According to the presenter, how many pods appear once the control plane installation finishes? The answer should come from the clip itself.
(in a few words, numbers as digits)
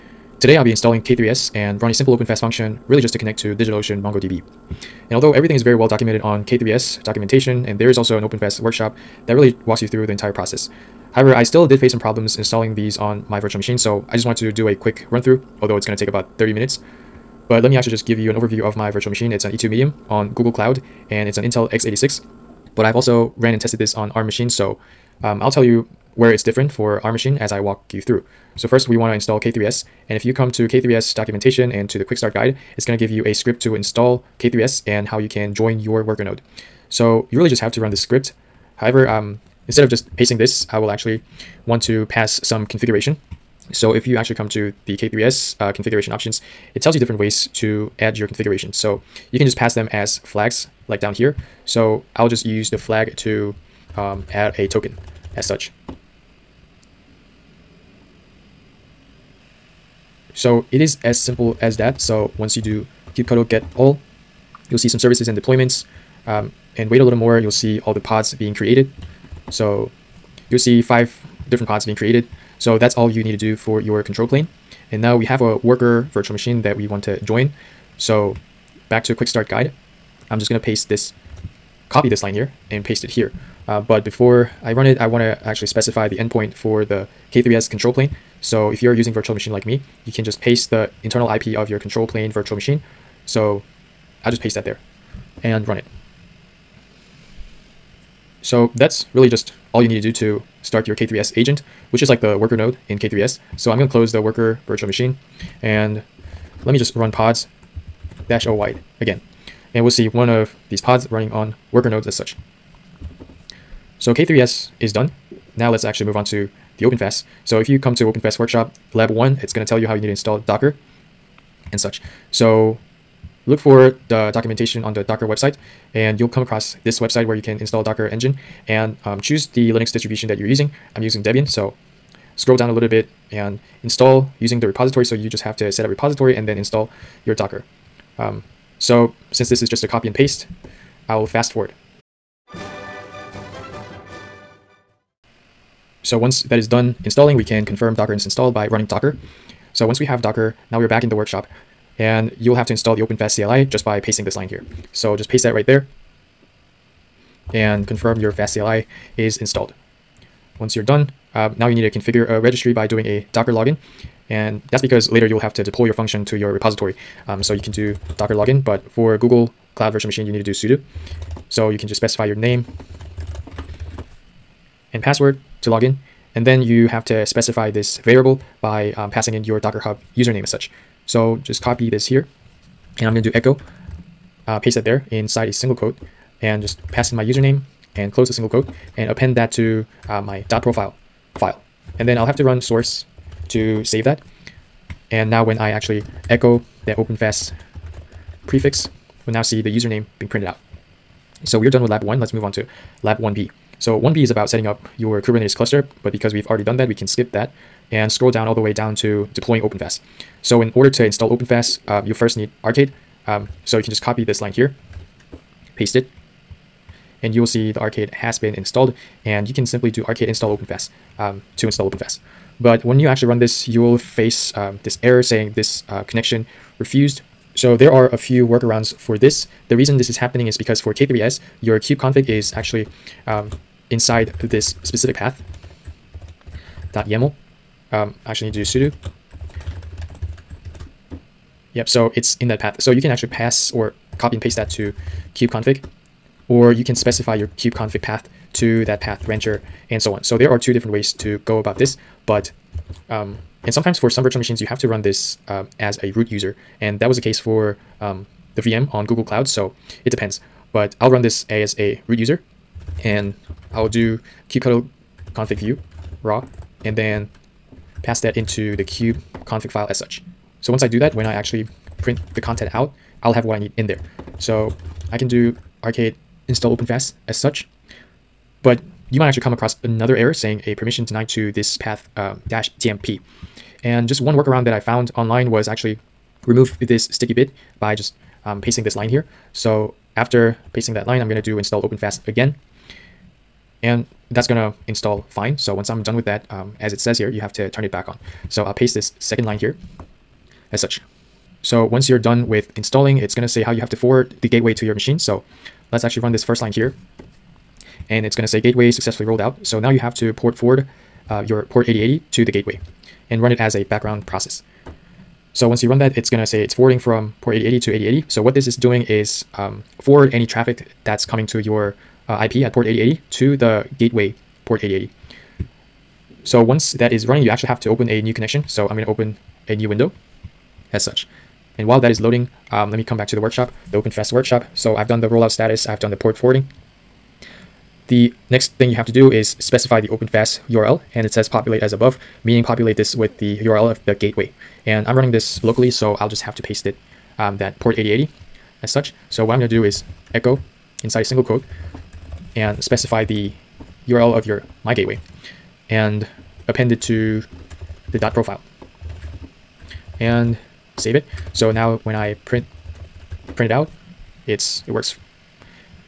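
5.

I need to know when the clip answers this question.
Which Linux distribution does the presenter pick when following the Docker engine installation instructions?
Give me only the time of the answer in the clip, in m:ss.
2:11.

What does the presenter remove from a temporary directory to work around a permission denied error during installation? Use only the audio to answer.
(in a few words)
sticky bit.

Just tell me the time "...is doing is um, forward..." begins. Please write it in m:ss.
5:18.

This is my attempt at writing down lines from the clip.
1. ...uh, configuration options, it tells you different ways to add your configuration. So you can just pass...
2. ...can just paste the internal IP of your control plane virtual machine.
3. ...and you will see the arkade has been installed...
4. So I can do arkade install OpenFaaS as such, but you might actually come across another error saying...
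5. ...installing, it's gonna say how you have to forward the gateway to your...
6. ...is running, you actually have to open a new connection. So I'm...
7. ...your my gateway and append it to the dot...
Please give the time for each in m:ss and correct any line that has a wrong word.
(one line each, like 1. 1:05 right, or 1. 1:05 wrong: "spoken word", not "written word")
1. 0:45 right
2. 1:30 right
3. 3:37 right
4. 4:34 right
5. 5:02 right
6. 5:27 right
7. 5:54 right.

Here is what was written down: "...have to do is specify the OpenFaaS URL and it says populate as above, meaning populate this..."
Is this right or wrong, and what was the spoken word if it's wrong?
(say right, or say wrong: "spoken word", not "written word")
right.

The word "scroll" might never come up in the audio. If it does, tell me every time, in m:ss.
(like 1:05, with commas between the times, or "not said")
2:12, 3:28.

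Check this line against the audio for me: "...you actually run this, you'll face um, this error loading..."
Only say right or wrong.
wrong.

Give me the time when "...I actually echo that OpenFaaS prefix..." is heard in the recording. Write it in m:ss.
3:15.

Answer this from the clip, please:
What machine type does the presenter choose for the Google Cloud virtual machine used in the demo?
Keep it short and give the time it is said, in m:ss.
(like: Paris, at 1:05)
E2 Medium, at 0:19.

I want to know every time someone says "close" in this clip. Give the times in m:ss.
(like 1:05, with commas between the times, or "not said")
1:43, 3:08.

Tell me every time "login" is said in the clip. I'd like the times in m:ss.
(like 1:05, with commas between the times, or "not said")
2:43, 2:48.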